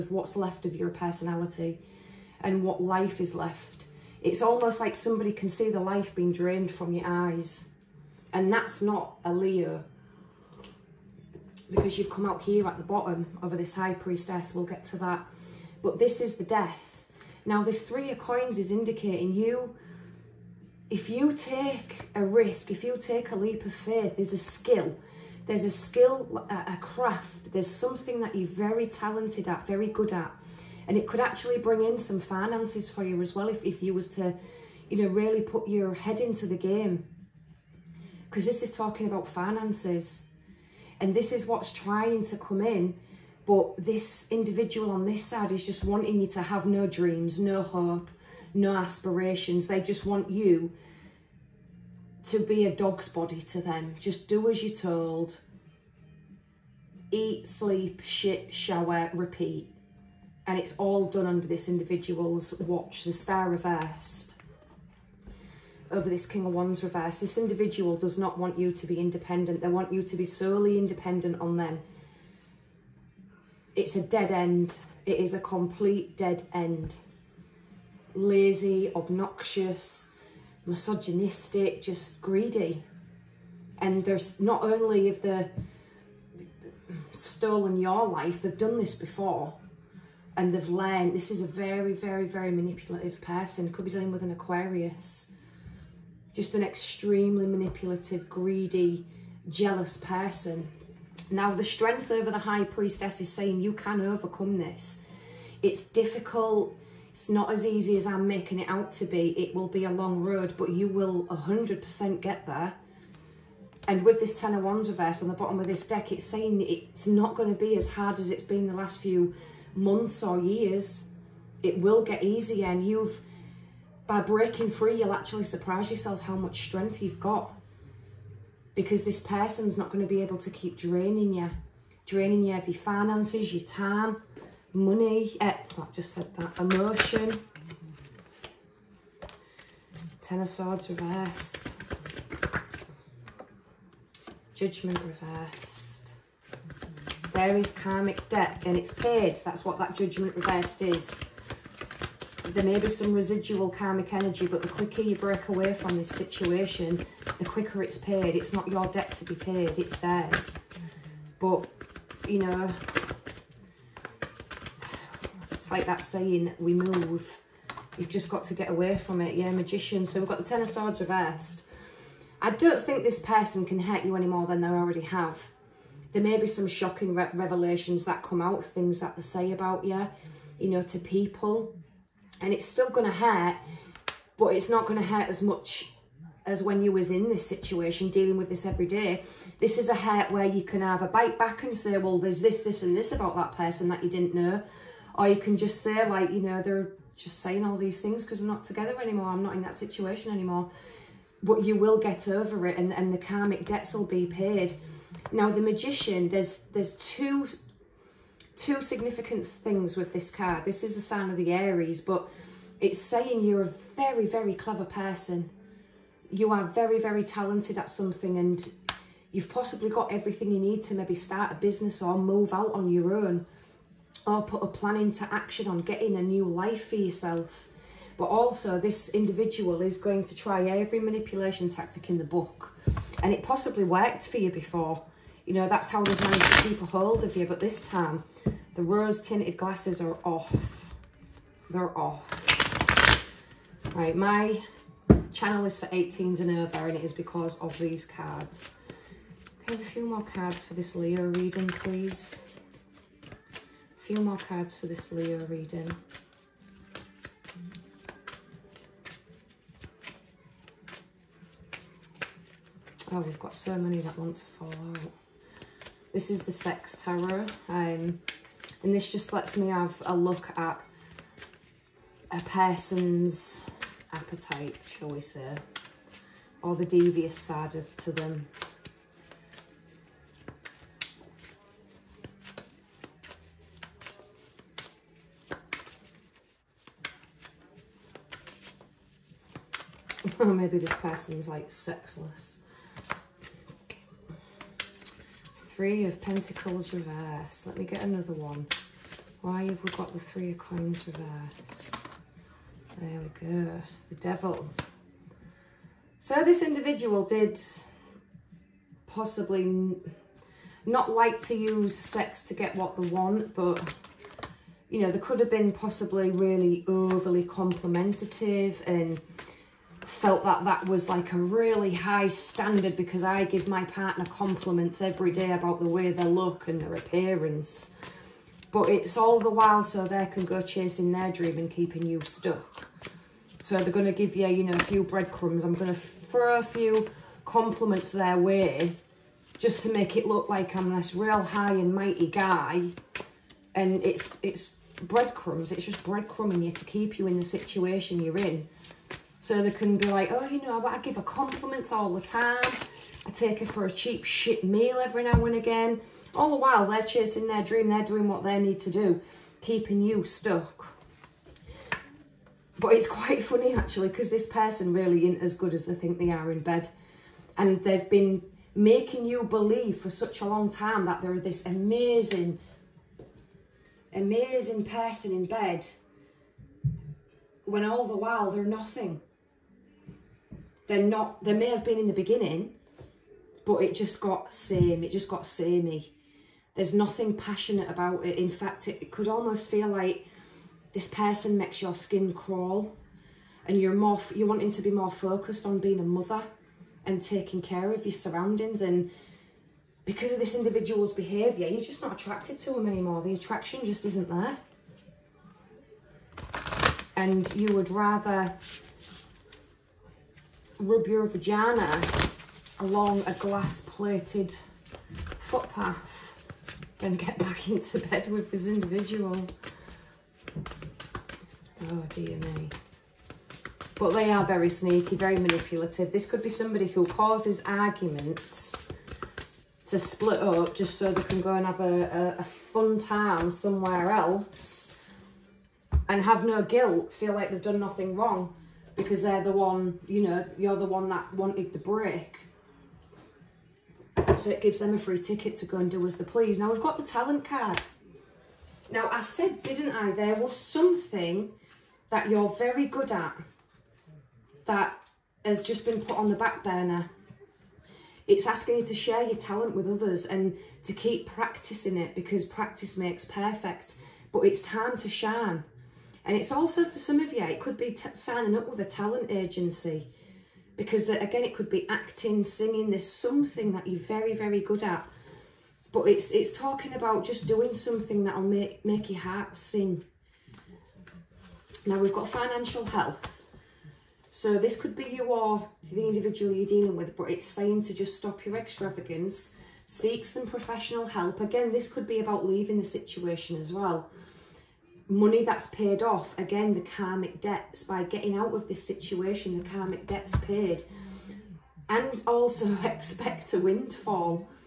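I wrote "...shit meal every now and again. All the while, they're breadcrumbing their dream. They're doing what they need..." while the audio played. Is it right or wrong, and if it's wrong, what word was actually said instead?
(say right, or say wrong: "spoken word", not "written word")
wrong: "chasing", not "breadcrumbing".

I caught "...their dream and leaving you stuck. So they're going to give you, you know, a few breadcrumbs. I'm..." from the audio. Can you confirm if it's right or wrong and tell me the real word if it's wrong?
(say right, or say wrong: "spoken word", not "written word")
wrong: "keeping", not "leaving".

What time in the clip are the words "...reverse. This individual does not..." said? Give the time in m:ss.
1:06.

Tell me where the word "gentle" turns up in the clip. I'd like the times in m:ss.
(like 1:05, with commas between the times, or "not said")
not said.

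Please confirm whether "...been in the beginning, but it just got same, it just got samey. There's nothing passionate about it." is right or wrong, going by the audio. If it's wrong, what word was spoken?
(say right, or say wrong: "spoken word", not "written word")
right.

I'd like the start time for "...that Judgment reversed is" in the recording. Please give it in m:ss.
2:29.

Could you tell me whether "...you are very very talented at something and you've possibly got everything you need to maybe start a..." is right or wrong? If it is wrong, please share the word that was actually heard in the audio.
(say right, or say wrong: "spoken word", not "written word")
right.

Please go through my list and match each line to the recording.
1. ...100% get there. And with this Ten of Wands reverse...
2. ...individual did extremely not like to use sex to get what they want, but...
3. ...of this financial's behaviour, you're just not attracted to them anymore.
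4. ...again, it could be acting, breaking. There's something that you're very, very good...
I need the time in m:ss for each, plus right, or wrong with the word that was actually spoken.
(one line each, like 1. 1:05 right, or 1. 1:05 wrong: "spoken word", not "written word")
1. 1:51 right
2. 5:06 wrong: "possibly", not "extremely"
3. 6:40 wrong: "individual", not "financial"
4. 7:51 wrong: "singing", not "breaking".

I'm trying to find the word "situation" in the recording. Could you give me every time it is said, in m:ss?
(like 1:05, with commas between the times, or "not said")
2:36, 3:07, 3:19, 5:47, 8:12, 8:18.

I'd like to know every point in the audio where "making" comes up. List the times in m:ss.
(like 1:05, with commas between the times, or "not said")
1:48, 6:08.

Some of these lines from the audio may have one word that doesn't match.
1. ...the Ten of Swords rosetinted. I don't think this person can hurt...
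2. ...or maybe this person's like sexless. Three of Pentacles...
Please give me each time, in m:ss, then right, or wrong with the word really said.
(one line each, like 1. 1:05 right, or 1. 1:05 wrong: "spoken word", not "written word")
1. 2:50 wrong: "reversed", not "rosetinted"
2. 4:50 right.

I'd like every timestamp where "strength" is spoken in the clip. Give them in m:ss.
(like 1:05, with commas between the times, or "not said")
1:41, 2:06.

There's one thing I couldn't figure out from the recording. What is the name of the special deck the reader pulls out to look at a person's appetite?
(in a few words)
Sex Tarot.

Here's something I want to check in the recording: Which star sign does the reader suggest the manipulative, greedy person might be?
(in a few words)
Aquarius.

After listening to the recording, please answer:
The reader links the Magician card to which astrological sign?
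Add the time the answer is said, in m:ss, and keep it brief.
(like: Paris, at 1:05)
Aries, at 3:31.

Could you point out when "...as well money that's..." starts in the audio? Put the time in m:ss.
8:13.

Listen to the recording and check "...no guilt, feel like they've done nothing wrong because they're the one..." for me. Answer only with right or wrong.
right.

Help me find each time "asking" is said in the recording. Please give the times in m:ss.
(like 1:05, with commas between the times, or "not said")
7:38.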